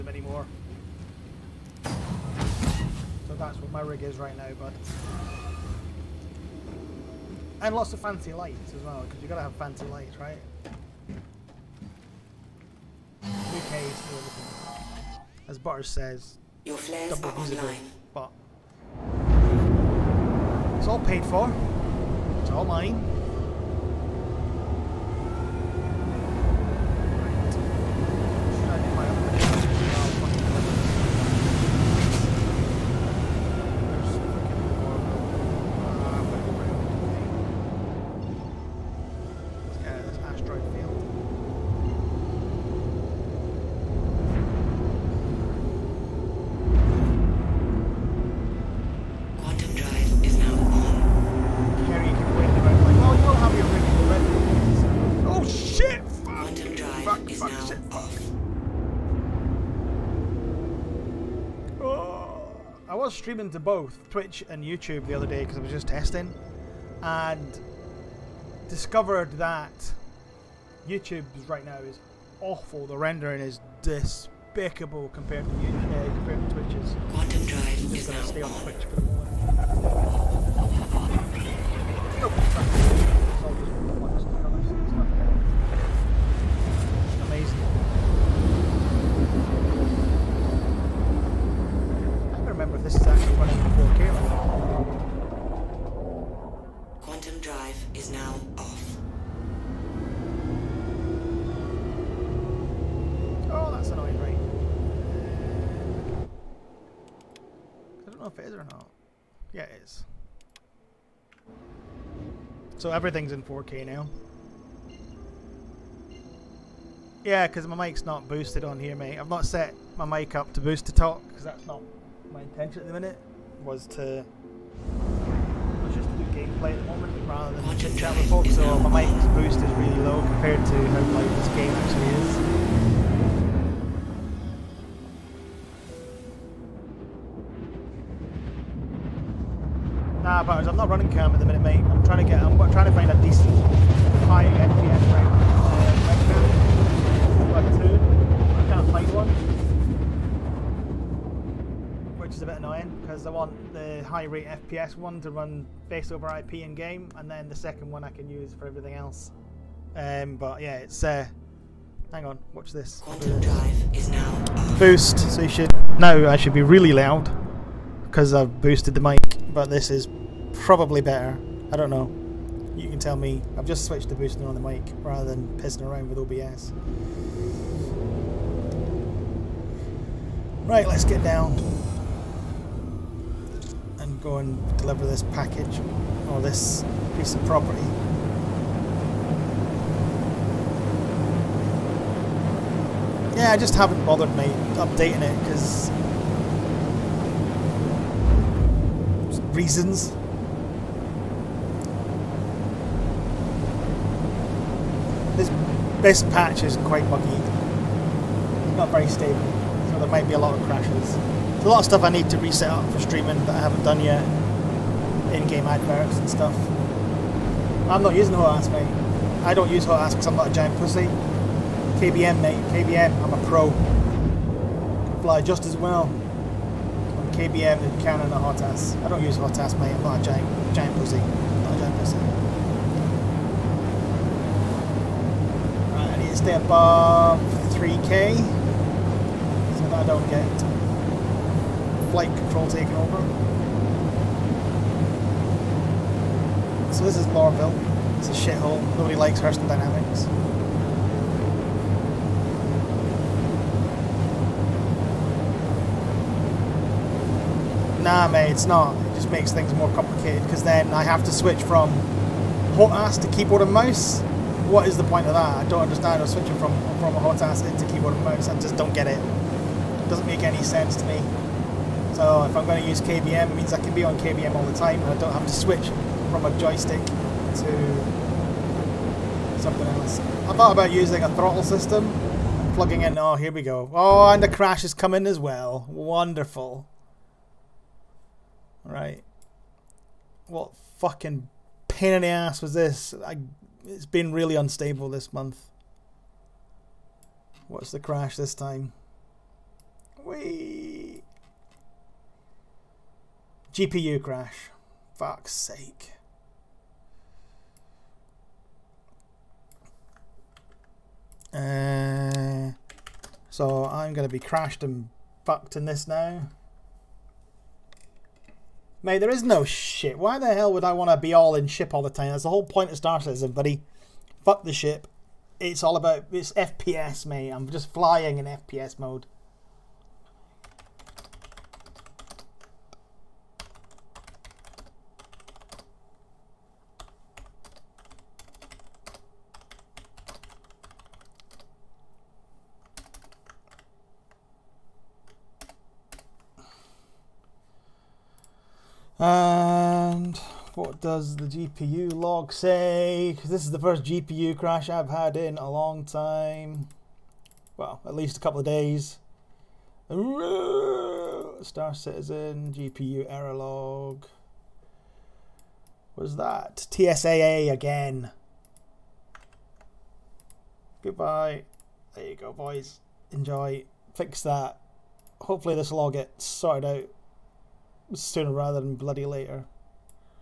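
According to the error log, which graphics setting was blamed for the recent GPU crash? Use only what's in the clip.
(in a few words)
TSAA.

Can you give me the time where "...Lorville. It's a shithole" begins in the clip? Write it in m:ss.
4:07.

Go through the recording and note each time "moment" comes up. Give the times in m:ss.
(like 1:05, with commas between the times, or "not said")
1:23, 2:06.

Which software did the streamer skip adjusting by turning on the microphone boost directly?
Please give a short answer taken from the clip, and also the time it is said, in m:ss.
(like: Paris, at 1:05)
OBS, at 2:56.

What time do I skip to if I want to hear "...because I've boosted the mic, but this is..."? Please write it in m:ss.
2:48.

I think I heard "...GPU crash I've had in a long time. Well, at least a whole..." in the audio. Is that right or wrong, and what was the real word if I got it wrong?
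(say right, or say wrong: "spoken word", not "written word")
wrong: "couple", not "whole".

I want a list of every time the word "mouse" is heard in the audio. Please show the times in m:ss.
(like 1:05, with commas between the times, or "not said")
4:23, 4:28.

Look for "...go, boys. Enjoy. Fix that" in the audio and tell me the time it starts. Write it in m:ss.
6:12.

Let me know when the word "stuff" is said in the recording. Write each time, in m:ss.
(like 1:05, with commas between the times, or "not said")
3:31, 3:36.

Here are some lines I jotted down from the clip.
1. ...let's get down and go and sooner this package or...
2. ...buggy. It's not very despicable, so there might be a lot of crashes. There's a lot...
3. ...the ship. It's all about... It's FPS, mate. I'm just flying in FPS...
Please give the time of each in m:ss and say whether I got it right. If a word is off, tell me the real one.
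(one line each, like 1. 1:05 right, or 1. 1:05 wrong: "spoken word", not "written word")
1. 3:00 wrong: "deliver", not "sooner"
2. 3:27 wrong: "stable", not "despicable"
3. 5:24 right.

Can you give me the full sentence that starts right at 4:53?
I it's been really unstable this month.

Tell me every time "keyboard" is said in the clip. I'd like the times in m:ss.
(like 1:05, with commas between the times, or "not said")
4:23, 4:27.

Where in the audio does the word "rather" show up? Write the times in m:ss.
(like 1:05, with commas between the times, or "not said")
2:07, 2:55, 6:18.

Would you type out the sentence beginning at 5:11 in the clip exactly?
Uh, so I'm going to be crashed and fucked in this now.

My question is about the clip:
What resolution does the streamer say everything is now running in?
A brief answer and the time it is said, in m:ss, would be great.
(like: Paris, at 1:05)
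4K, at 1:53.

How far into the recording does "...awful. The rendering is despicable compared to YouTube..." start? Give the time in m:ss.
1:12.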